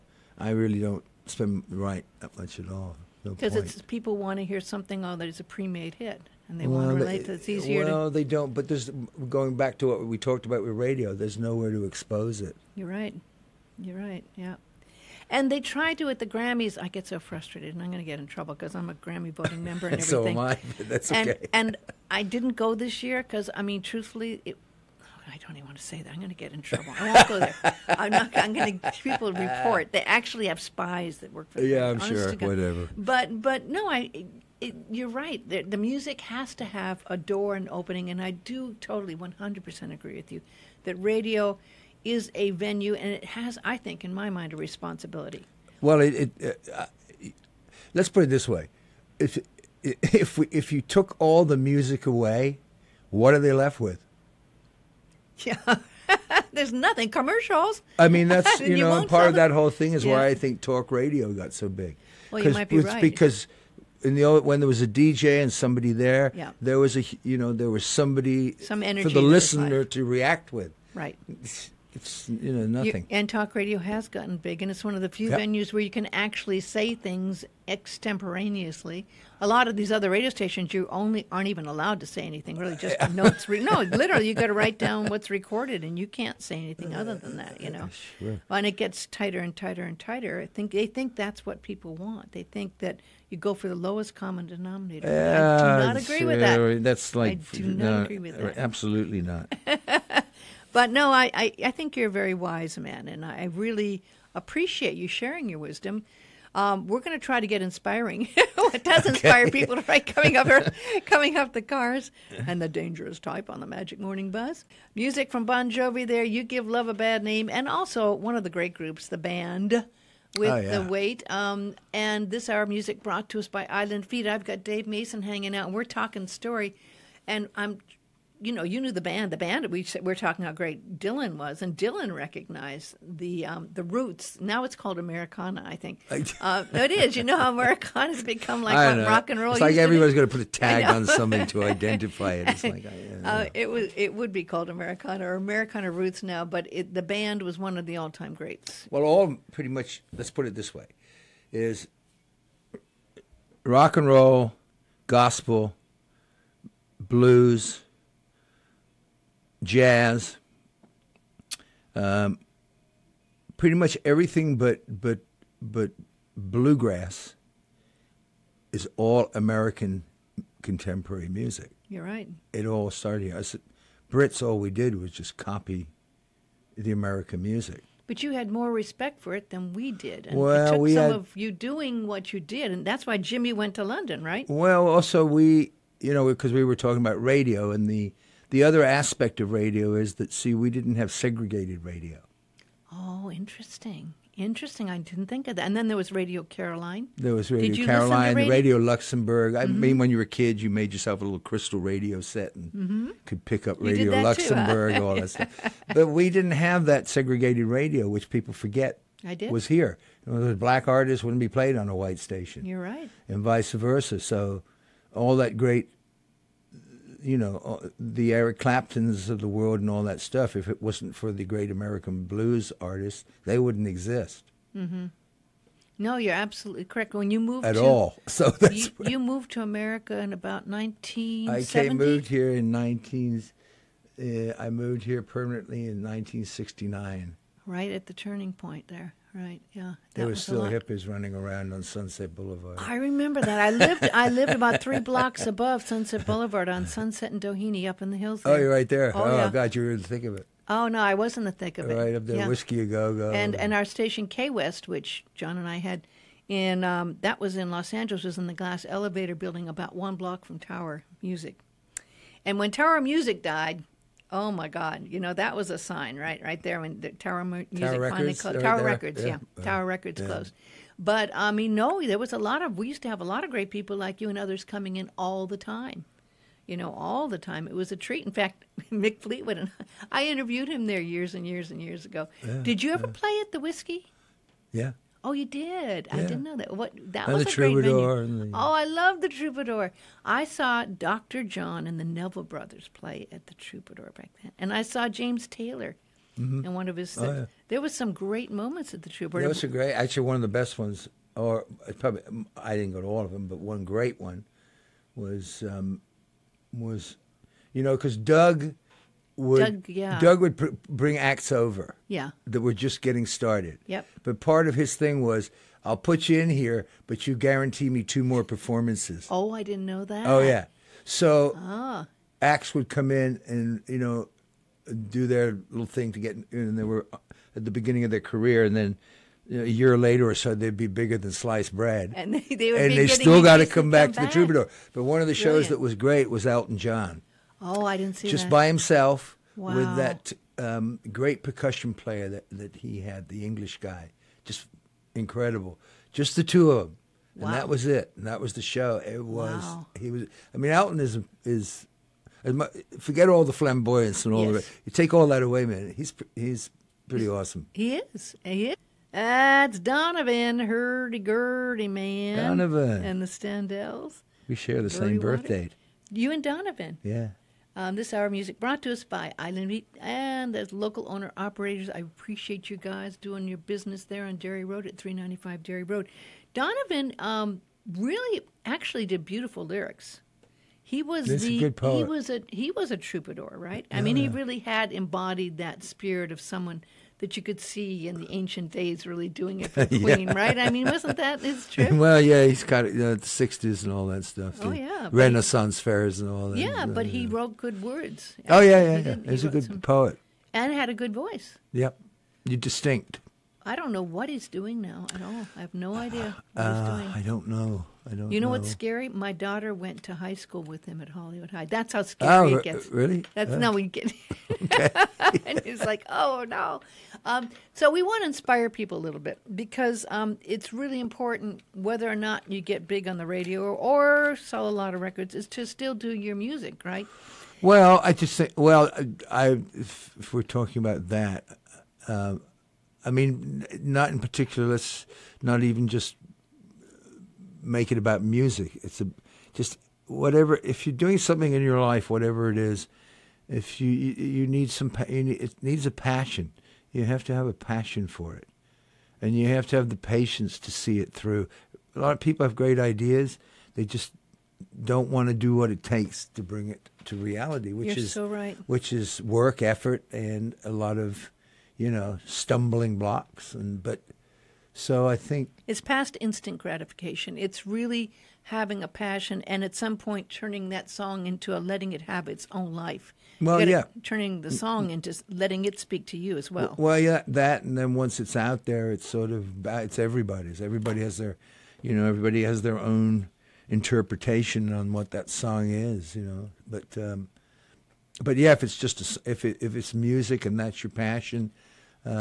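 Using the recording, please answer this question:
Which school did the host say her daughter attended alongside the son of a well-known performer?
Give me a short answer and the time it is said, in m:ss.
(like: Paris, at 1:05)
Hollywood High, at 6:51.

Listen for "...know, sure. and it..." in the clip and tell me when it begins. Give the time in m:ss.
1:27.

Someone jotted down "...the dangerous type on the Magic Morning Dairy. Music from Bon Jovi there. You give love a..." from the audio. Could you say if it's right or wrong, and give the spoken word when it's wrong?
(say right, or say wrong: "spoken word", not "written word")
wrong: "Buzz", not "Dairy".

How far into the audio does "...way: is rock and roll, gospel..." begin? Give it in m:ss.
2:30.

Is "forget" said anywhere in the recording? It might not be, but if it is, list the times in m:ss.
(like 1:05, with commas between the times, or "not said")
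3:28, 5:52.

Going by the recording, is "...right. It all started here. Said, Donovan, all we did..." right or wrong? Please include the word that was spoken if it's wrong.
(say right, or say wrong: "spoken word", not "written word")
wrong: "Brits", not "Donovan".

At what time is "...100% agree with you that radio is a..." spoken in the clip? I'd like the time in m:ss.
0:39.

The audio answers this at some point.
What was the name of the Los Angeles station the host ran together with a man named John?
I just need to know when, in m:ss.
4:14.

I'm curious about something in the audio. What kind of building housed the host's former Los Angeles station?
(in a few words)
glass elevator building.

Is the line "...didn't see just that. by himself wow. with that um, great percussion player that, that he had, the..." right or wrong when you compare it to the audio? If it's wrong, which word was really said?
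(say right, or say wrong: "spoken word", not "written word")
right.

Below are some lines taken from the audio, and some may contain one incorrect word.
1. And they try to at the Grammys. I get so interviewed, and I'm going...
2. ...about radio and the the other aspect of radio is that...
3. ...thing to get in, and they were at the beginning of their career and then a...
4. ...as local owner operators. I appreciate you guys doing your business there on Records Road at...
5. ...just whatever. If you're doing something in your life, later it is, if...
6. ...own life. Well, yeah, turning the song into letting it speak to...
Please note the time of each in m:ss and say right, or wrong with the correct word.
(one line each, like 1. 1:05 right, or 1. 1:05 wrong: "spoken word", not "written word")
1. 0:15 wrong: "frustrated", not "interviewed"
2. 3:06 right
3. 5:25 right
4. 6:10 wrong: "Dairy", not "Records"
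5. 7:19 wrong: "whatever", not "later"
6. 7:52 right.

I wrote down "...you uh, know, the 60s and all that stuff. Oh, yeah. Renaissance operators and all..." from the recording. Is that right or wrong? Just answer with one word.
wrong.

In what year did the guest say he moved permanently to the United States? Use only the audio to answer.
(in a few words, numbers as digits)
1969.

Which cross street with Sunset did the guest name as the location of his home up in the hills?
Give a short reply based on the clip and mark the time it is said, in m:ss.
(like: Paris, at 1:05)
Doheny, at 4:07.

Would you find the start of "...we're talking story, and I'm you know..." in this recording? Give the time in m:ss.
2:05.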